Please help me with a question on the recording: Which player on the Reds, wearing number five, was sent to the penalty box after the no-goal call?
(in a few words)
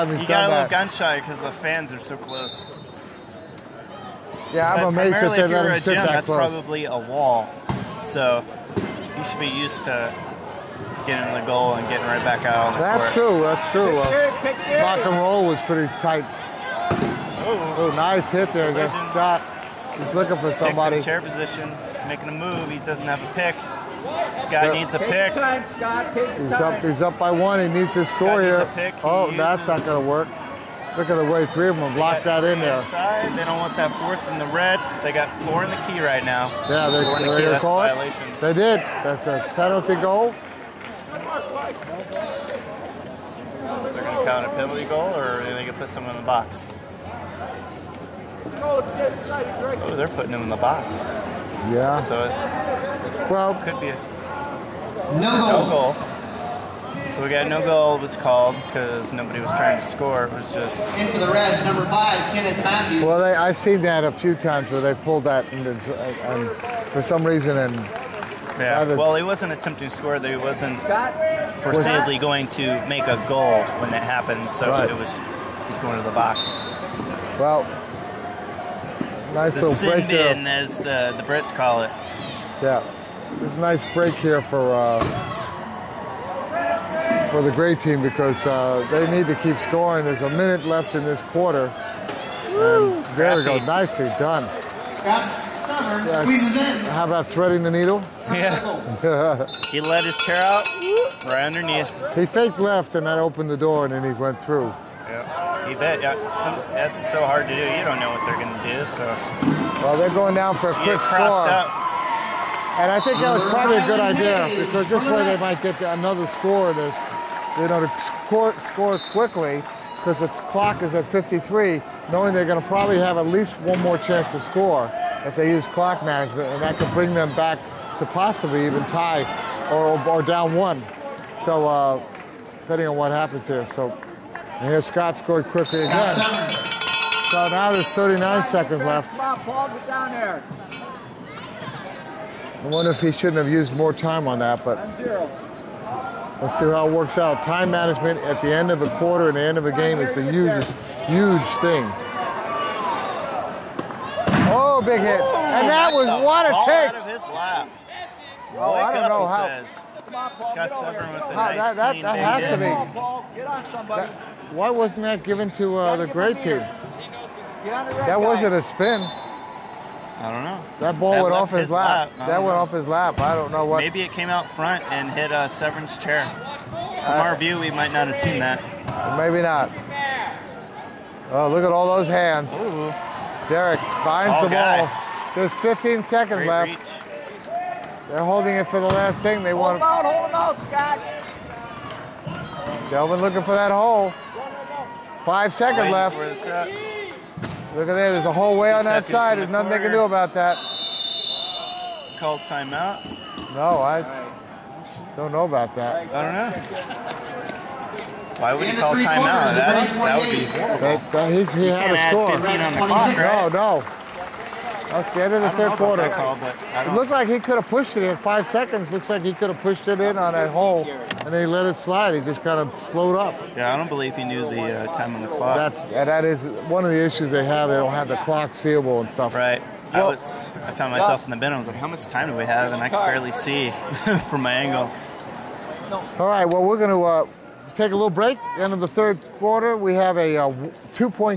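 Kenneth Matthews.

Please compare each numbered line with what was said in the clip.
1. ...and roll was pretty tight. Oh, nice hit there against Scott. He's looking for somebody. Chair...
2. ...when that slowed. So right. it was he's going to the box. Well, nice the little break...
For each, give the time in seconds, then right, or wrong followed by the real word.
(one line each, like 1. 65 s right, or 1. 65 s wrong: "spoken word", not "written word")
1. 15 s right
2. 73 s wrong: "happened", not "slowed".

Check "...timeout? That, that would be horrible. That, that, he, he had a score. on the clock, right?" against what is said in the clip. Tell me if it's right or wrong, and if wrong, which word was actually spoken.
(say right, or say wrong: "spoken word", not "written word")
right.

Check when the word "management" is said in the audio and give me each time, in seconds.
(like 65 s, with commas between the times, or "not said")
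126 s, 147 s.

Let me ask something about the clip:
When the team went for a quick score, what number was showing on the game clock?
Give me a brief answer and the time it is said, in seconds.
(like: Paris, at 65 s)
53, at 121 s.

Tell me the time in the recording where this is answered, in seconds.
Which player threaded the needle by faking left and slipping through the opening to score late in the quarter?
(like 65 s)
94 s.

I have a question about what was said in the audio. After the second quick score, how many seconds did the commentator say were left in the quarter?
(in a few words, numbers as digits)
39.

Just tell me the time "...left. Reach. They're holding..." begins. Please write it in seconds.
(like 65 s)
186 s.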